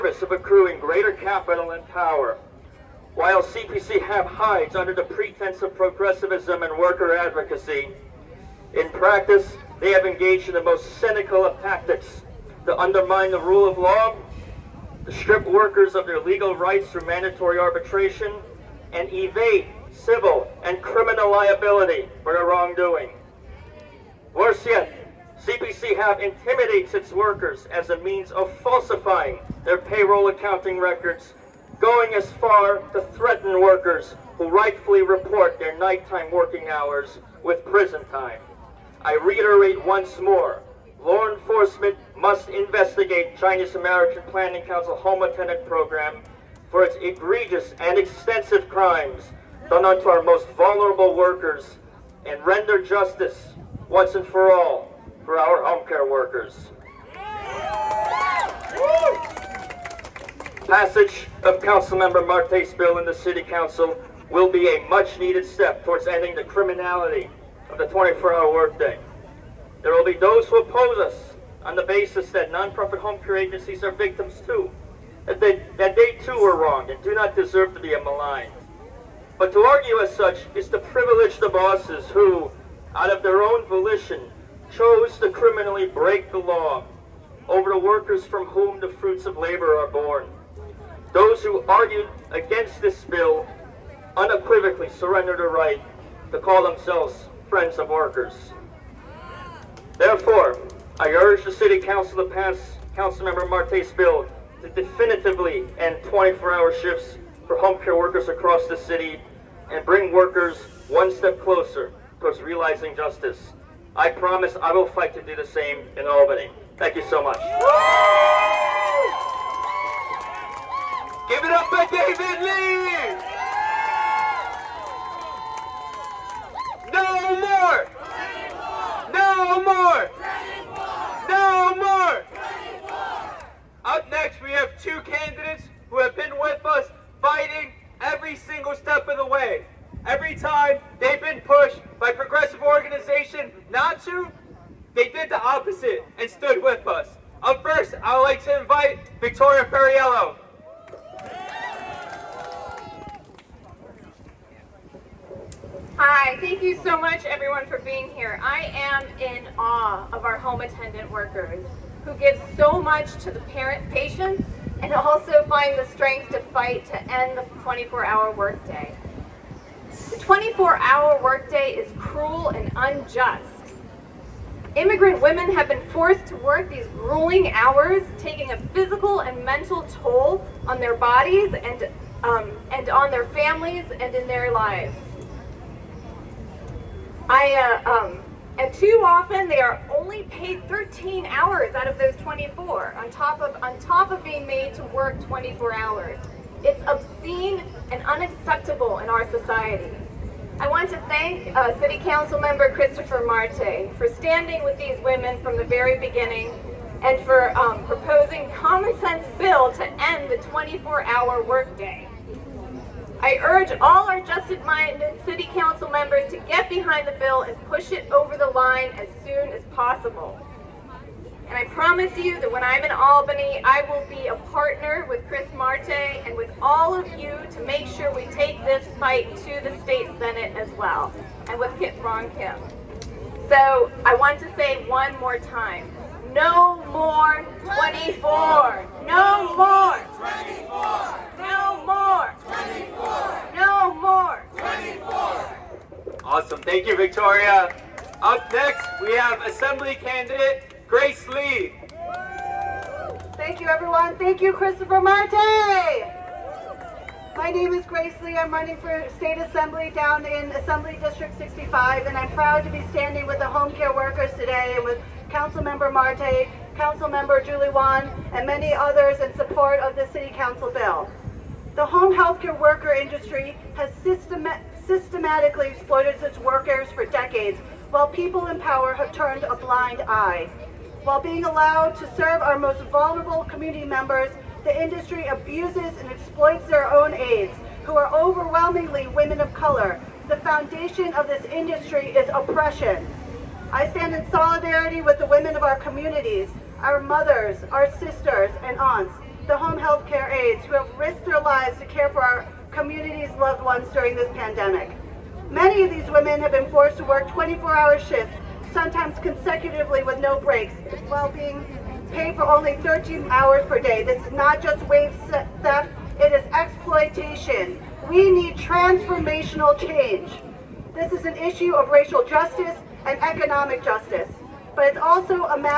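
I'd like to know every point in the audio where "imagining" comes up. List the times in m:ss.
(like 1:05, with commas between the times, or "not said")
not said.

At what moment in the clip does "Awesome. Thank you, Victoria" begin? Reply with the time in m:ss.
4:06.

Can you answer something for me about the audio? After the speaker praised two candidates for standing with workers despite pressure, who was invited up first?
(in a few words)
Victoria Fariello.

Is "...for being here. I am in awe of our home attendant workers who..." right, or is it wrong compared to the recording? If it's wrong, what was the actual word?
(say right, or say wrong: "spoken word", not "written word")
right.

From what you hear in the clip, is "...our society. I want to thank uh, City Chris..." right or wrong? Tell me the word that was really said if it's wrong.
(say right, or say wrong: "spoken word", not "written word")
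wrong: "Council", not "Chris".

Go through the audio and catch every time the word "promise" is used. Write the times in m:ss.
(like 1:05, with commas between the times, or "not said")
1:54, 3:41.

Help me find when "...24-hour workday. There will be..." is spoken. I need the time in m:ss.
1:07.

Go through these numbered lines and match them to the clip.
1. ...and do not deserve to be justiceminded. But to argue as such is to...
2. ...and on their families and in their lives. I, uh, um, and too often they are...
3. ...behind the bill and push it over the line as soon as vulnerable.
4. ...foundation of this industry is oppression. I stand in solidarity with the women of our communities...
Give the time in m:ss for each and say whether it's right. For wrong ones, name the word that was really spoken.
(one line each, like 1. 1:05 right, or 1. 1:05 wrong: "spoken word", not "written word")
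1. 1:16 wrong: "maligned", not "justiceminded"
2. 3:02 right
3. 3:36 wrong: "possible", not "vulnerable"
4. 4:50 right.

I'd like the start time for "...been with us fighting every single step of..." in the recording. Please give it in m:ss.
2:16.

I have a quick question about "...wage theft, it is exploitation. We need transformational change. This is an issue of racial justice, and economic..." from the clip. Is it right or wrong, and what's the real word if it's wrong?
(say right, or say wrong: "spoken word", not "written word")
right.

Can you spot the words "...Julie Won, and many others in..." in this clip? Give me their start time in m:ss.
4:27.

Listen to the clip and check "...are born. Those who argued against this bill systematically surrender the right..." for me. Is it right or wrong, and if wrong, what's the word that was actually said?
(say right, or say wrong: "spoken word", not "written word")
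wrong: "unequivocally", not "systematically".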